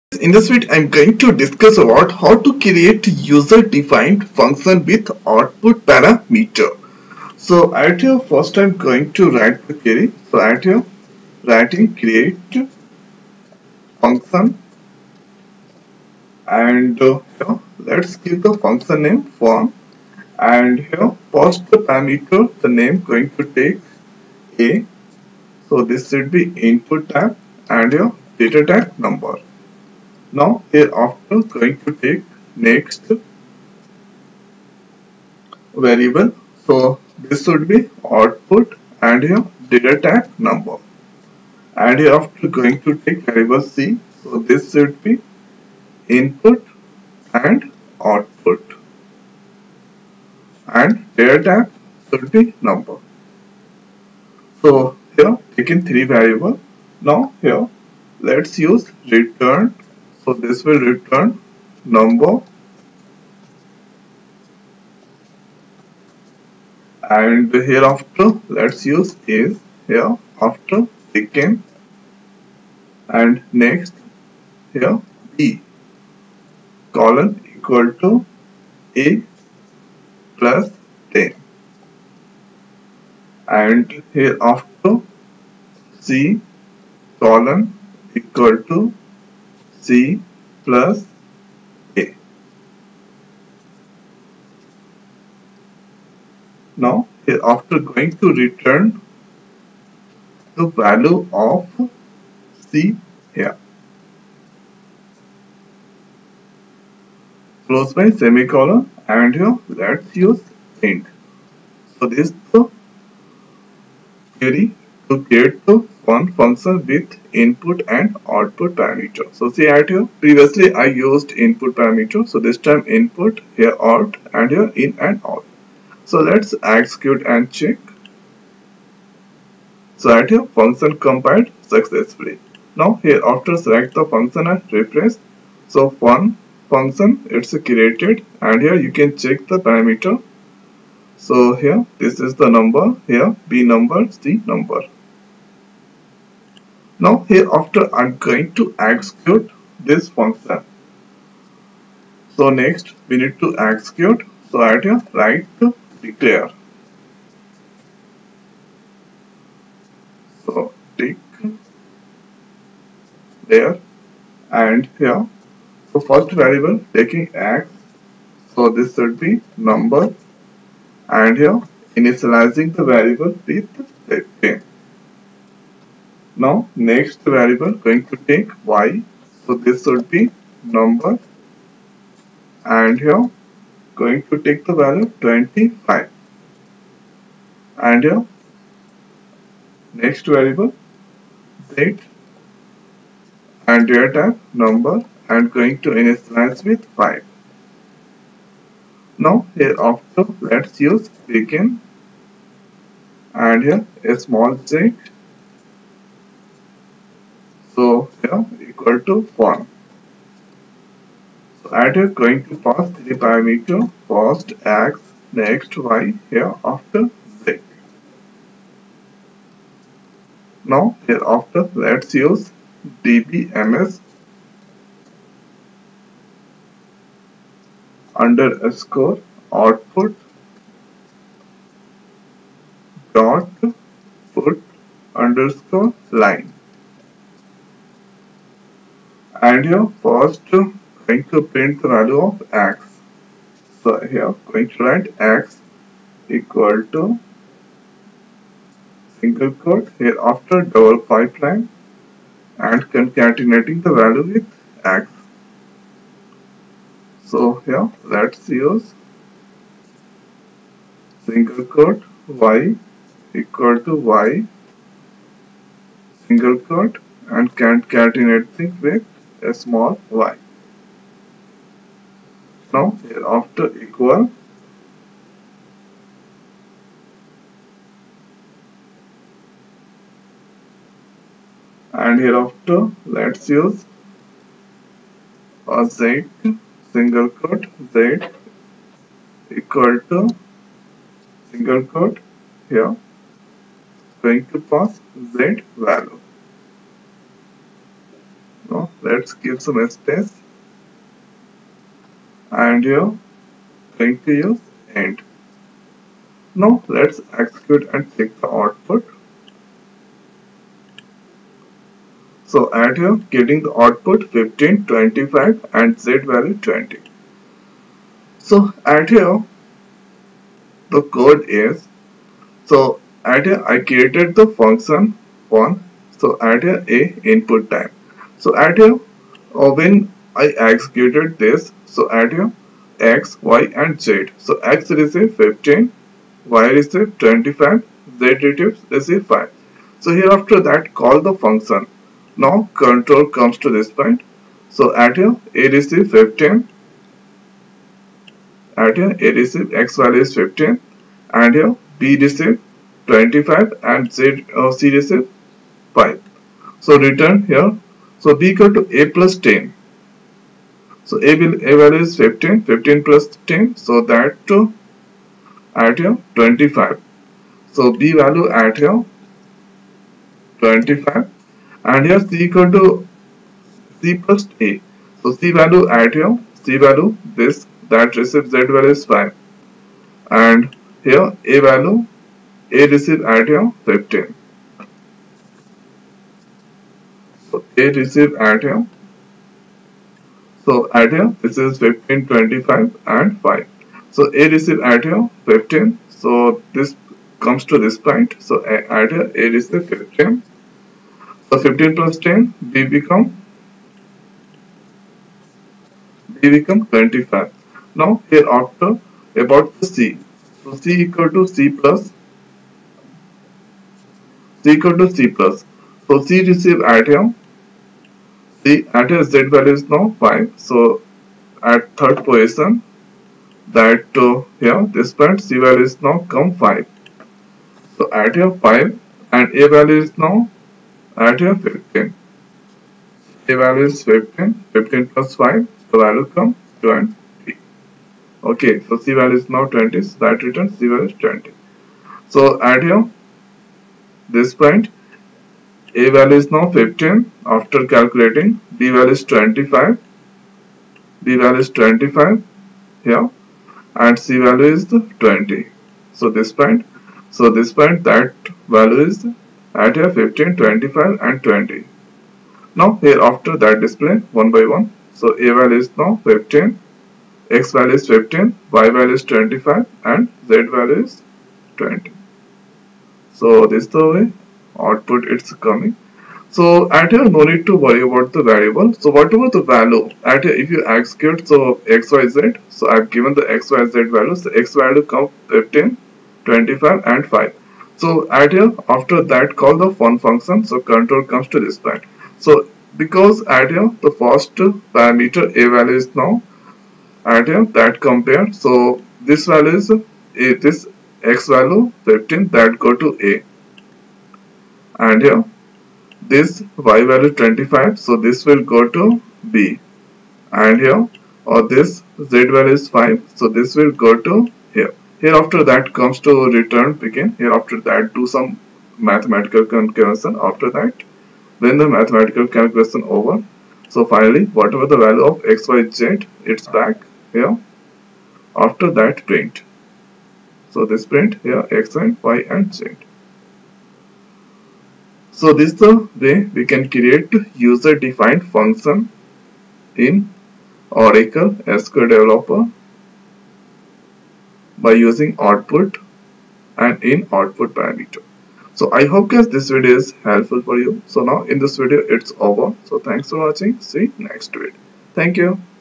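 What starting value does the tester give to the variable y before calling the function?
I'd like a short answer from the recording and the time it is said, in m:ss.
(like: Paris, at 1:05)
25, at 3:04.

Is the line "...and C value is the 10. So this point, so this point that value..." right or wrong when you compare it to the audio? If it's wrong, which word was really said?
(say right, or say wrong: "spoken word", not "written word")
wrong: "20", not "10".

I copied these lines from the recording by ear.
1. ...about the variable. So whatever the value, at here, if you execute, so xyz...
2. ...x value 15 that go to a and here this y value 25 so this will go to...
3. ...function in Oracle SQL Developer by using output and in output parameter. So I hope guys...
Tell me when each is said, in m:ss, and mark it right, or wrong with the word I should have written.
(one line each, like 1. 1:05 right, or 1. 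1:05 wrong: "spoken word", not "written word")
1. 7:58 right
2. 8:21 right
3. 8:58 right.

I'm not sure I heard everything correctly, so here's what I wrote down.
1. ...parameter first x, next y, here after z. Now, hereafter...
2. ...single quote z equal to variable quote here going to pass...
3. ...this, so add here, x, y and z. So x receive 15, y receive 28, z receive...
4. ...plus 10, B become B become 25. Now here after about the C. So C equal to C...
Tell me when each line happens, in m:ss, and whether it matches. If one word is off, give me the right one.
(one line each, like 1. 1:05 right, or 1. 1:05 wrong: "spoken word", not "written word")
1. 3:33 right
2. 4:46 wrong: "single", not "variable"
3. 5:31 wrong: "25", not "28"
4. 6:41 right.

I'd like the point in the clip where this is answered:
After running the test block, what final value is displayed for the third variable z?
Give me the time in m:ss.
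5:16.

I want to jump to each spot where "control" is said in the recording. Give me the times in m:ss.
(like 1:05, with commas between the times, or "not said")
5:42, 8:10.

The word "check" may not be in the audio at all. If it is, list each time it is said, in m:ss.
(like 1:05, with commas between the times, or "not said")
2:07, 2:19, 5:08.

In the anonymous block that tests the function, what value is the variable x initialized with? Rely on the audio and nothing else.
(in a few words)
15.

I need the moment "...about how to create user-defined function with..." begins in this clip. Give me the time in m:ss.
0:01.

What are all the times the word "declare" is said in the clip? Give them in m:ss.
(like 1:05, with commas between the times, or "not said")
2:36.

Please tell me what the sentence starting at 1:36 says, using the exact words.
Now, after going to return the value of C here.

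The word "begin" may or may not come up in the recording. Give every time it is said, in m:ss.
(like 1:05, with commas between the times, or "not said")
3:21, 8:37.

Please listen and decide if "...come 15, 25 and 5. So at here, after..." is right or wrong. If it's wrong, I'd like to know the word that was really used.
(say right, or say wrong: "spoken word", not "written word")
right.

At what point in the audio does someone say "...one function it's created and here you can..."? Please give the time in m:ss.
2:16.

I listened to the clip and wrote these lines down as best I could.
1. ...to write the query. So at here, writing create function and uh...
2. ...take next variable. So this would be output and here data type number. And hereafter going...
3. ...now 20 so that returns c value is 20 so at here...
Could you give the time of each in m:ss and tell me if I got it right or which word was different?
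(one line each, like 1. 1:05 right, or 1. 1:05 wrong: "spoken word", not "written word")
1. 0:09 right
2. 0:31 right
3. 7:19 right.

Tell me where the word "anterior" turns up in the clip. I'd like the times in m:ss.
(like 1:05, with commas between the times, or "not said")
6:58.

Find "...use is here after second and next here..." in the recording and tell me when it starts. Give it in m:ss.
1:08.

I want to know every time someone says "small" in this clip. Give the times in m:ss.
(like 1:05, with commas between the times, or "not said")
3:24, 4:29.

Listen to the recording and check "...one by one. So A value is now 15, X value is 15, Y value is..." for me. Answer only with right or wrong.
right.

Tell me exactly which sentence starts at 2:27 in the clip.
Now hereafter I'm going to execute this function.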